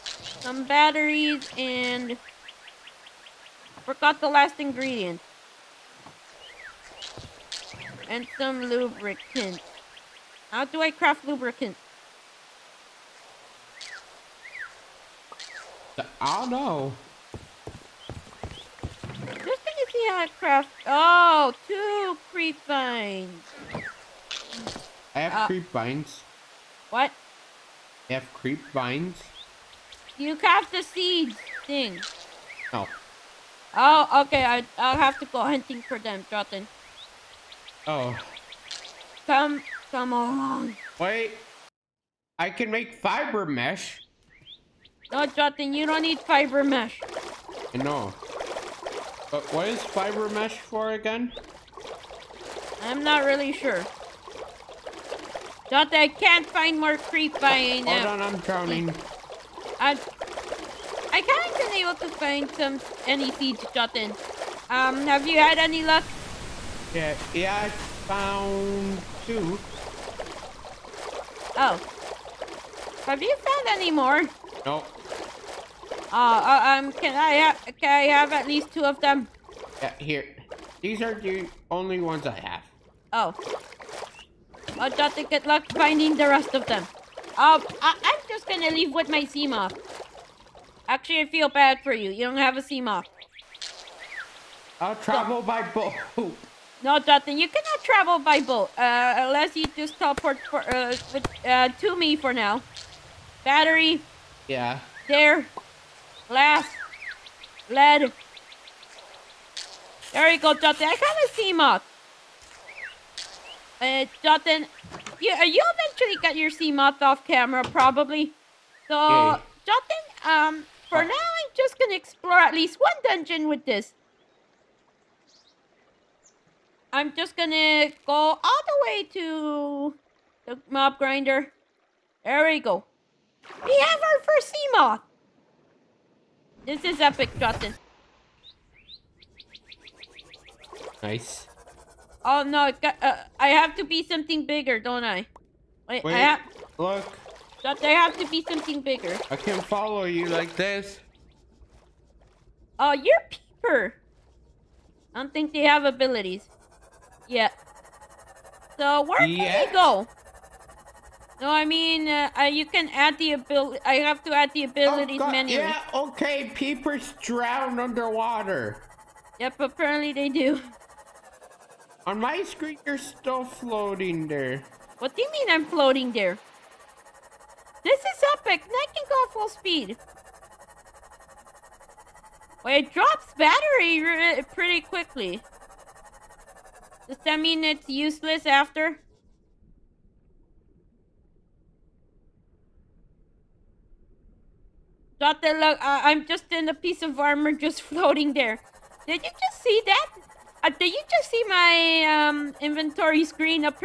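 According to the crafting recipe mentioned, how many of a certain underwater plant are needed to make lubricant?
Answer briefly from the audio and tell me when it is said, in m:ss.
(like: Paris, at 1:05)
2, at 0:21.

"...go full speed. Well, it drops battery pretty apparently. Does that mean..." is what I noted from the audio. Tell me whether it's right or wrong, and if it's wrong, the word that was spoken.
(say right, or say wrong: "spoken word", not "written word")
wrong: "quickly", not "apparently".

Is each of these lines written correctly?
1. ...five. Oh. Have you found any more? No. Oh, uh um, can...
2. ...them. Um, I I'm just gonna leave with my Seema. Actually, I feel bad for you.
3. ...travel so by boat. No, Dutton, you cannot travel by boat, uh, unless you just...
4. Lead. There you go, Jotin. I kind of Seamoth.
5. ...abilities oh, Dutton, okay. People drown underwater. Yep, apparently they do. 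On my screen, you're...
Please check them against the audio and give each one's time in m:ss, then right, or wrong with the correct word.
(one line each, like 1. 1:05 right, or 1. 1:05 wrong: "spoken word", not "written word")
1. 1:09 wrong: "two", not "five"
2. 1:26 right
3. 1:34 right
4. 1:47 wrong: "Dutton", not "Jotin"
5. 2:44 wrong: "Yeah", not "Dutton".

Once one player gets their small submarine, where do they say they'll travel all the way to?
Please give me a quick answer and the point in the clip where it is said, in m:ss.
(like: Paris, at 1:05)
The mob grinder, at 2:10.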